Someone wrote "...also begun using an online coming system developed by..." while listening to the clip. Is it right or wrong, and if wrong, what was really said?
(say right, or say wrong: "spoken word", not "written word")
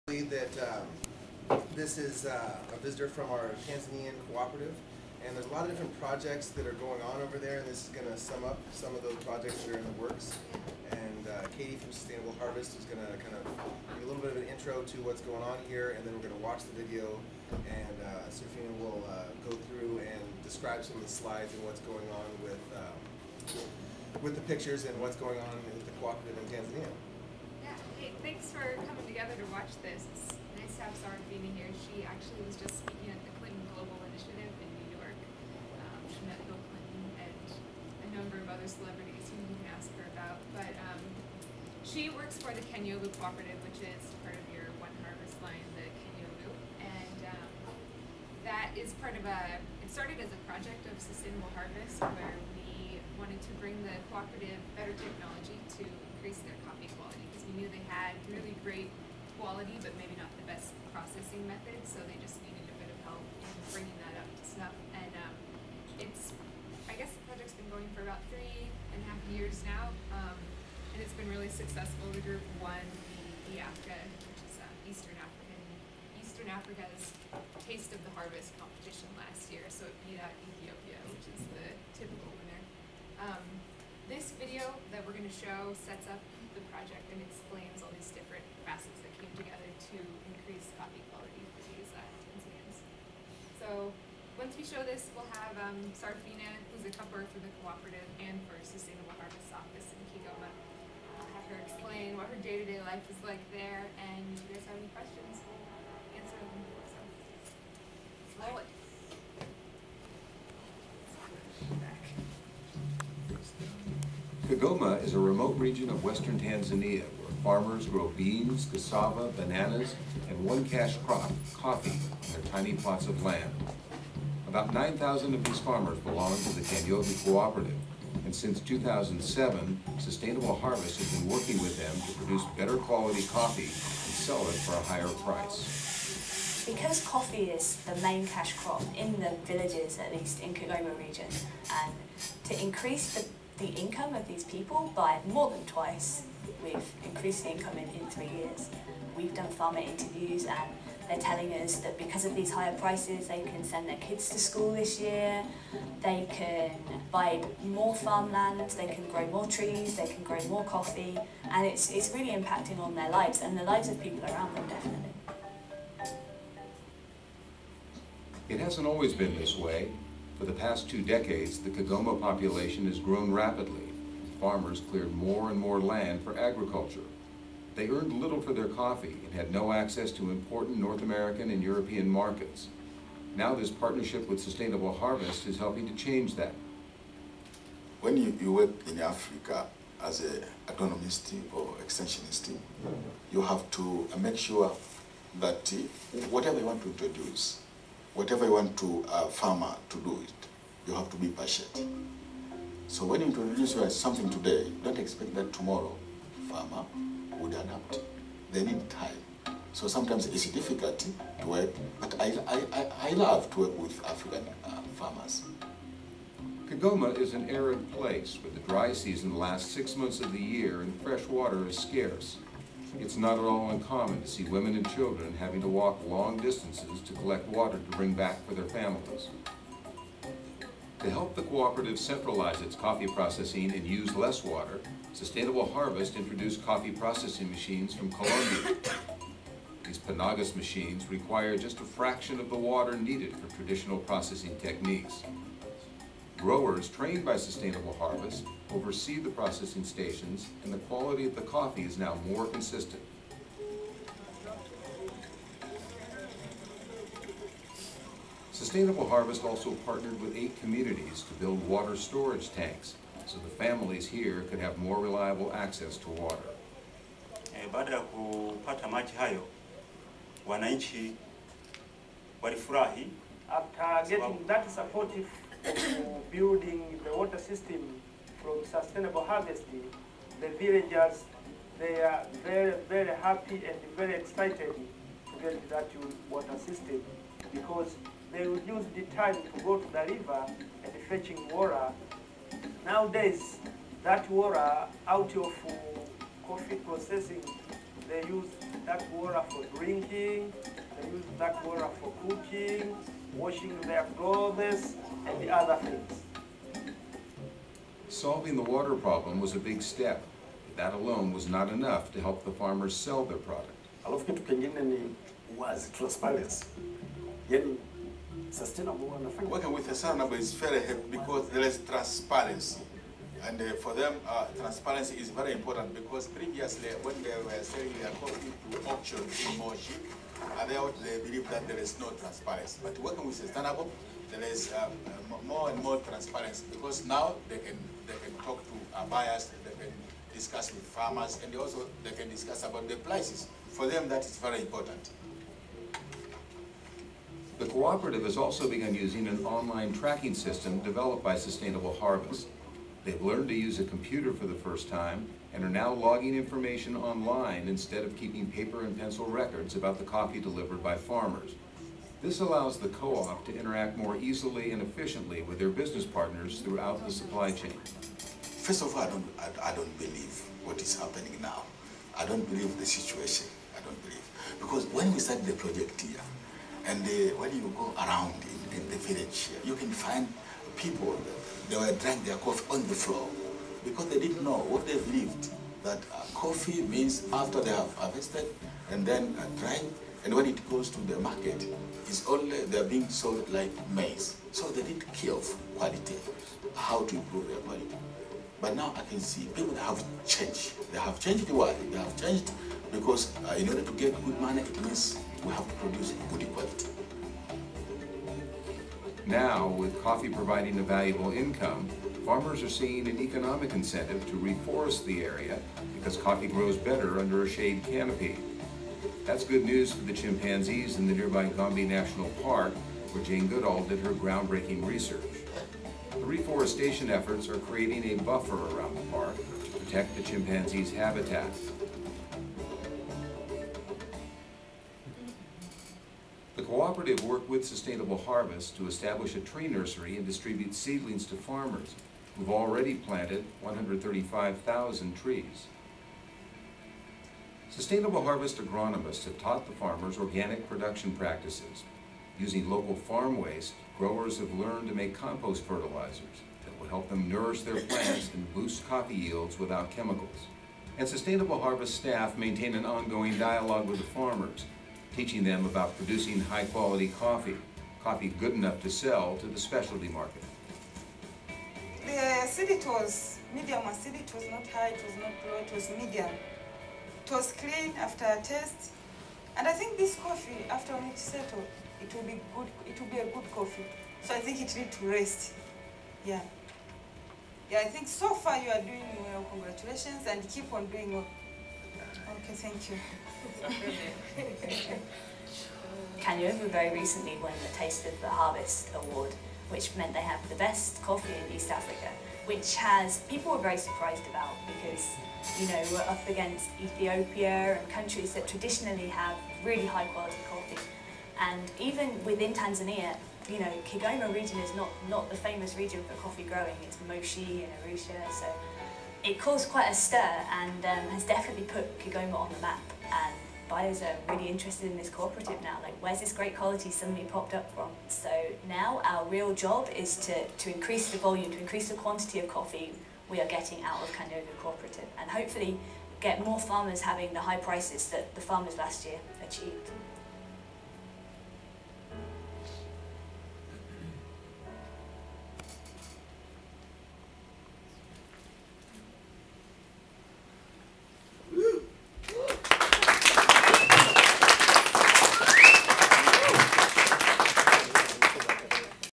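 wrong: "tracking", not "coming".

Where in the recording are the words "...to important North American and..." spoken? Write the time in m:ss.
3:00.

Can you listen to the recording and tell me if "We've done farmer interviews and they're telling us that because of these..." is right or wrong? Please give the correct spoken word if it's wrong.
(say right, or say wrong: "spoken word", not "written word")
right.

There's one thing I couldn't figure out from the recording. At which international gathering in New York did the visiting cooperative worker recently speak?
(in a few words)
Clinton Global Initiative.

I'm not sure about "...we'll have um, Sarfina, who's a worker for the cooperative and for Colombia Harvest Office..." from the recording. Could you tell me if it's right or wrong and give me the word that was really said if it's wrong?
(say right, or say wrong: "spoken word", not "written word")
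wrong: "Sustainable", not "Colombia".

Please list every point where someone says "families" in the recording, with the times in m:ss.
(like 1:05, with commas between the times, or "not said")
3:48, 4:23.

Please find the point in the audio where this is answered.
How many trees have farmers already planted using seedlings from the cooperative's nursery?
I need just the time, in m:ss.
7:23.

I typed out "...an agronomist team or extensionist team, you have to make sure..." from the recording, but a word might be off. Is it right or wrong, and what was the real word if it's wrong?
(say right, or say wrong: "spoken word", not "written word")
right.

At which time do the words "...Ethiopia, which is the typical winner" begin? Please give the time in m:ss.
1:20.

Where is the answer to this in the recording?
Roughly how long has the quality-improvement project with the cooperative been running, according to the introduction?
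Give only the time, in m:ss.
1:08.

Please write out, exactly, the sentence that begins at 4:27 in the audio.
Eh, baada ya kupata maji hayo, wananchi walifurahi.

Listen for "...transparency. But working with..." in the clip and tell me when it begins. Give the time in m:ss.
5:32.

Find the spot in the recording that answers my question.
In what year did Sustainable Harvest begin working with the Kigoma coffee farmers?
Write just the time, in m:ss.
2:08.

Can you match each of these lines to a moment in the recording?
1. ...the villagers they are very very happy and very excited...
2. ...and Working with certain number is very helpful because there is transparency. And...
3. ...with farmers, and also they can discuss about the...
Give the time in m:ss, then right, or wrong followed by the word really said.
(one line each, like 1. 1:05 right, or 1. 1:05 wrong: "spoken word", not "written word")
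1. 4:40 right
2. 5:19 right
3. 5:40 right.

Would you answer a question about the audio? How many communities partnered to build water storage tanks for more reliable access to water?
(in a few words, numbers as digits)
eight.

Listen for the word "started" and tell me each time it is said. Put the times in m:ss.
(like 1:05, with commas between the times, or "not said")
0:49, 6:15.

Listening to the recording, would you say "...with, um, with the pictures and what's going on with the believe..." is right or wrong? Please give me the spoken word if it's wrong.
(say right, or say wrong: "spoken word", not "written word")
wrong: "cooperative", not "believe".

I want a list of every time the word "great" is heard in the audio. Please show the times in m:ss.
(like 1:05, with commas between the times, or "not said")
0:58, 8:46.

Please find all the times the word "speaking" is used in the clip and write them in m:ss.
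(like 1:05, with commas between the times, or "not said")
0:32.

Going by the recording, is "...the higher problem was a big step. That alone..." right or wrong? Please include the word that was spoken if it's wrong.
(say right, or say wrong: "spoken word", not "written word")
wrong: "water", not "higher".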